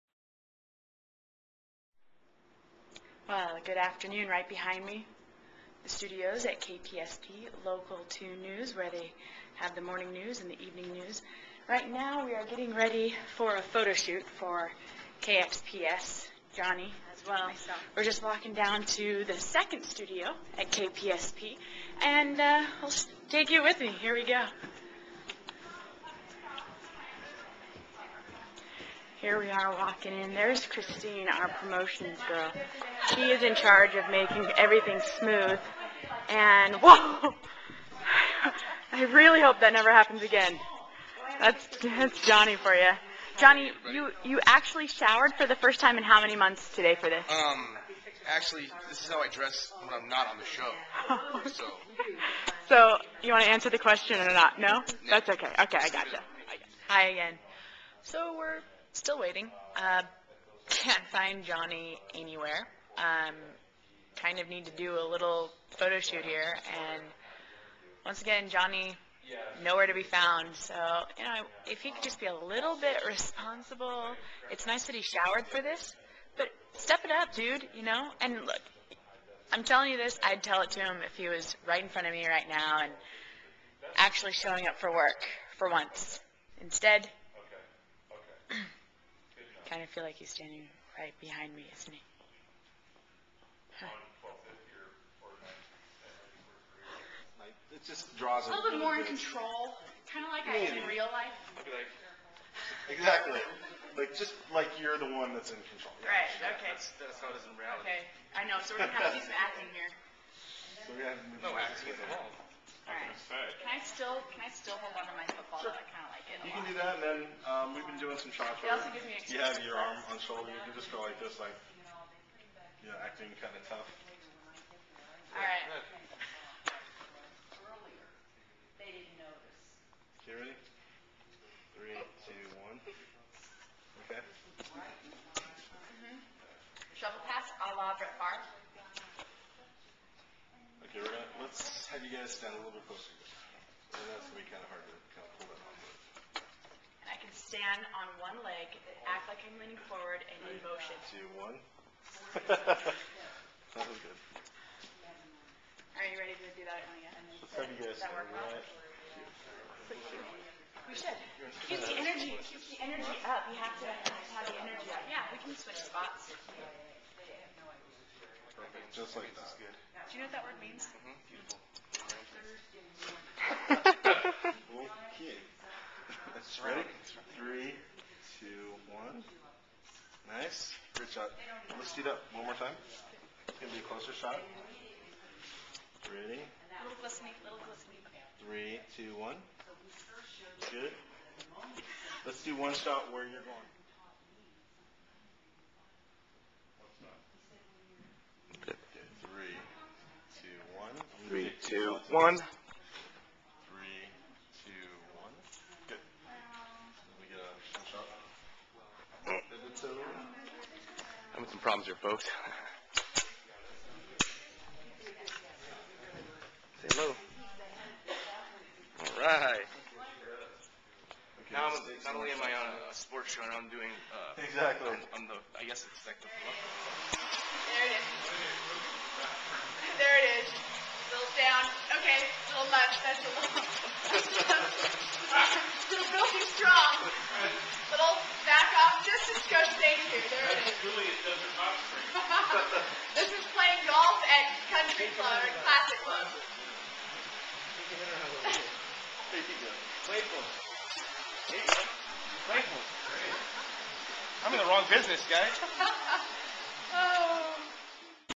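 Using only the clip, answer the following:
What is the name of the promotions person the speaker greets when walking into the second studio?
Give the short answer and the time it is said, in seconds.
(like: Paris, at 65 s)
Christine, at 30 s.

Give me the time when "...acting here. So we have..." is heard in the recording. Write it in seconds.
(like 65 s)
109 s.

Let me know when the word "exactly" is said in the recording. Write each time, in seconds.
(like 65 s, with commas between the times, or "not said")
102 s, 224 s.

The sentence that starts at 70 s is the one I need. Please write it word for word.
So, you know, if he could just be a little bit responsible.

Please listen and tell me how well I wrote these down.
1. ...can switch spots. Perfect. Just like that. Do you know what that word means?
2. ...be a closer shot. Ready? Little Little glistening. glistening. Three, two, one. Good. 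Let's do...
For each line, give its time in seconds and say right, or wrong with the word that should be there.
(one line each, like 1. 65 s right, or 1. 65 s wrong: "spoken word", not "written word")
1. 165 s right
2. 183 s right.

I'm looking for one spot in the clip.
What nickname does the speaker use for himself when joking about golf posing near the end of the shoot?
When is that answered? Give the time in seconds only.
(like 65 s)
239 s.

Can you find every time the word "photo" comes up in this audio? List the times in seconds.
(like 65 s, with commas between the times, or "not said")
13 s, 65 s.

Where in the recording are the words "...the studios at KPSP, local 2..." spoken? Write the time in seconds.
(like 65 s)
5 s.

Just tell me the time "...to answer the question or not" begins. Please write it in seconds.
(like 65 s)
53 s.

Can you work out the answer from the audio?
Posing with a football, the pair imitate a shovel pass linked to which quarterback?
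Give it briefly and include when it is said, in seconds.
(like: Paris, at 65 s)
Brett Favre, at 137 s.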